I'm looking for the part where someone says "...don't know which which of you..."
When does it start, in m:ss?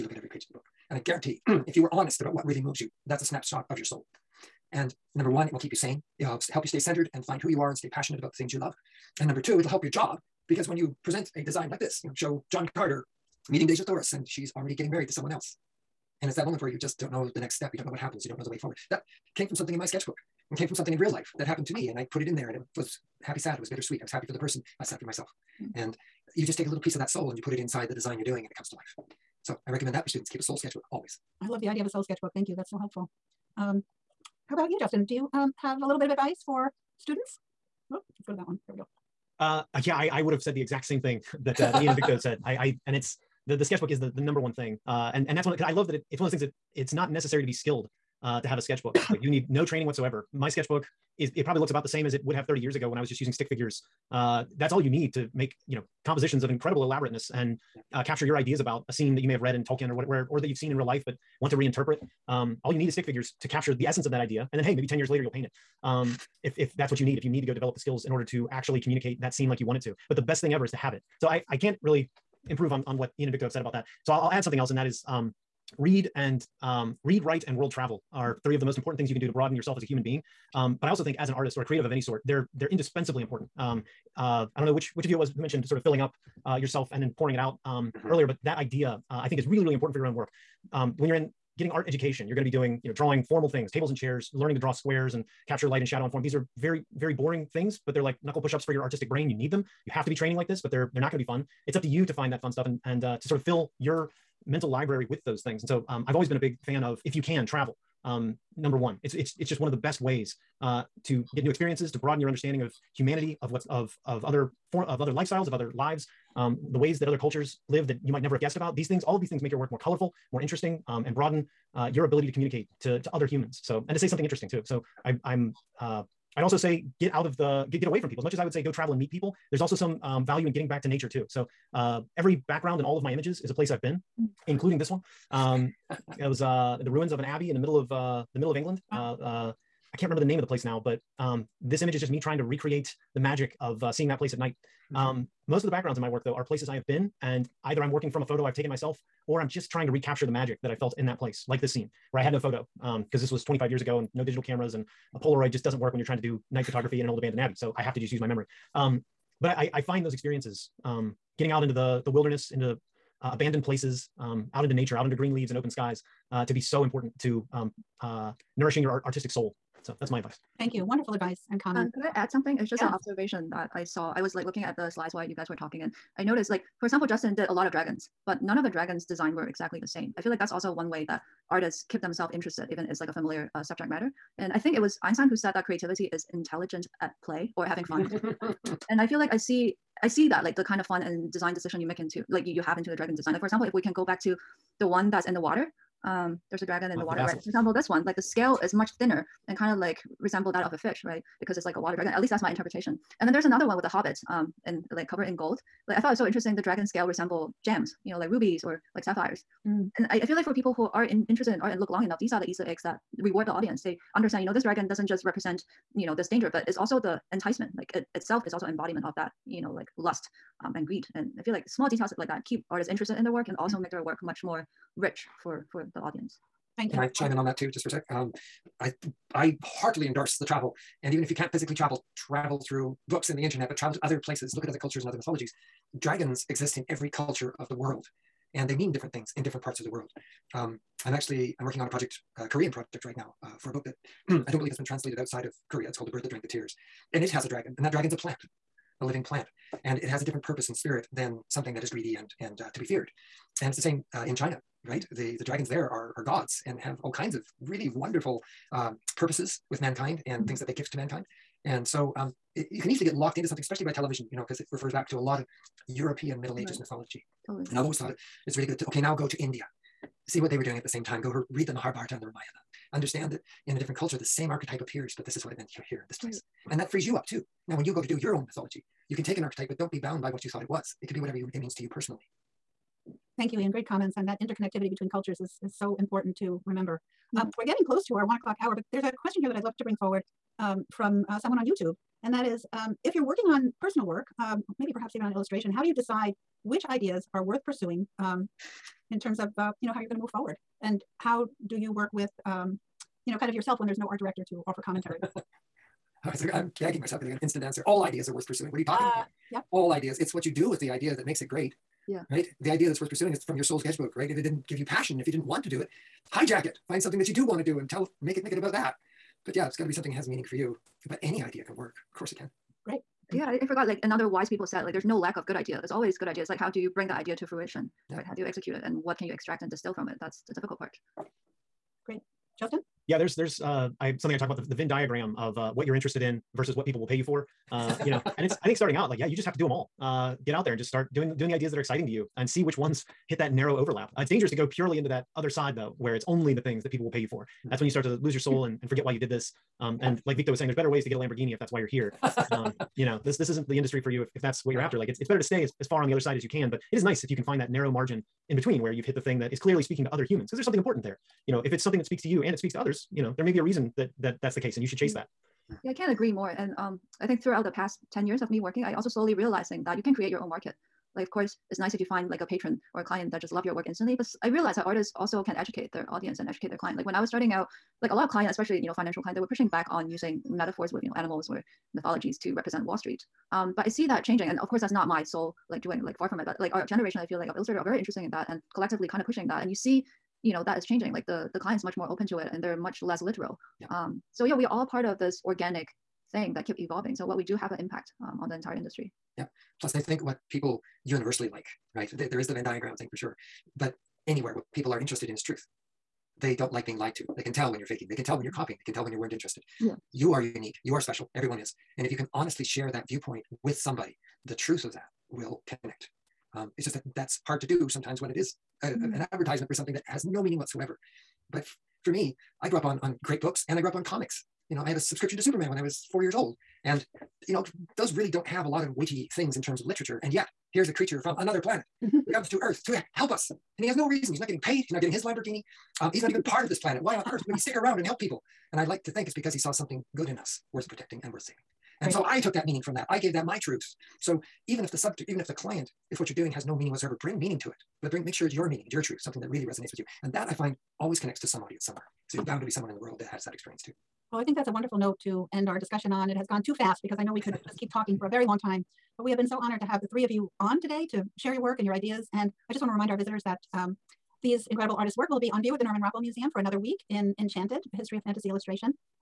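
1:24.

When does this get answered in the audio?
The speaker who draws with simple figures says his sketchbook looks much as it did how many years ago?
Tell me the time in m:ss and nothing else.
0:52.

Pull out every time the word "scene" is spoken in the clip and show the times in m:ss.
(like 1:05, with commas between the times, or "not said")
0:58, 1:09, 2:31.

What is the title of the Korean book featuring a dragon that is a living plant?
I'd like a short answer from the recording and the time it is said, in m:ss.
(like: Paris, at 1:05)
The Bird That Drank the Tears, at 4:06.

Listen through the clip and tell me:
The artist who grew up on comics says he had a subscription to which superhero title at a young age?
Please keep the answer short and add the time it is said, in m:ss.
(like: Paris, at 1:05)
Superman, at 7:05.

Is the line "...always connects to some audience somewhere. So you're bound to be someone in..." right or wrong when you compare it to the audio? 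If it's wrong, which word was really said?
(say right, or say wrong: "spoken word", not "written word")
right.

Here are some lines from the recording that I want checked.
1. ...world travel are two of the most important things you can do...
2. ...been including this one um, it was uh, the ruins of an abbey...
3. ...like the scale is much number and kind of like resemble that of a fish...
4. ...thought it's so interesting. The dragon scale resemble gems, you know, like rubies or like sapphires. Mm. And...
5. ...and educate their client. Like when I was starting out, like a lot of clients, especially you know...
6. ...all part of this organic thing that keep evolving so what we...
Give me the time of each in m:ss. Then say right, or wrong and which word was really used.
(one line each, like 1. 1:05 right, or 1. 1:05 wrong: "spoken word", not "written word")
1. 1:17 wrong: "three", not "two"
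2. 2:13 right
3. 3:18 wrong: "thinner", not "number"
4. 3:25 right
5. 6:16 right
6. 6:34 right.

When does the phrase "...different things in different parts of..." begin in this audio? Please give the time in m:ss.
3:58.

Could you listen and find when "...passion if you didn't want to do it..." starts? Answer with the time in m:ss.
5:14.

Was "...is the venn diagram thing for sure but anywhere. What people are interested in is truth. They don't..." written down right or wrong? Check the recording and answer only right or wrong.
right.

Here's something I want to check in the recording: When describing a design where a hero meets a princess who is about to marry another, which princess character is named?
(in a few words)
Deja Thoris.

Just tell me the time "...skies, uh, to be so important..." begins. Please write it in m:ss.
2:45.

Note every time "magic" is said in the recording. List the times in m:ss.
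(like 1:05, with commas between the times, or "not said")
2:23, 2:30.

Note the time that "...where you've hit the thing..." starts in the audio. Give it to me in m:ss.
5:58.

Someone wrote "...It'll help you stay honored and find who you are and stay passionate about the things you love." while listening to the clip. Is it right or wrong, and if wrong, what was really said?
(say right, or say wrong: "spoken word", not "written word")
wrong: "centered", not "honored".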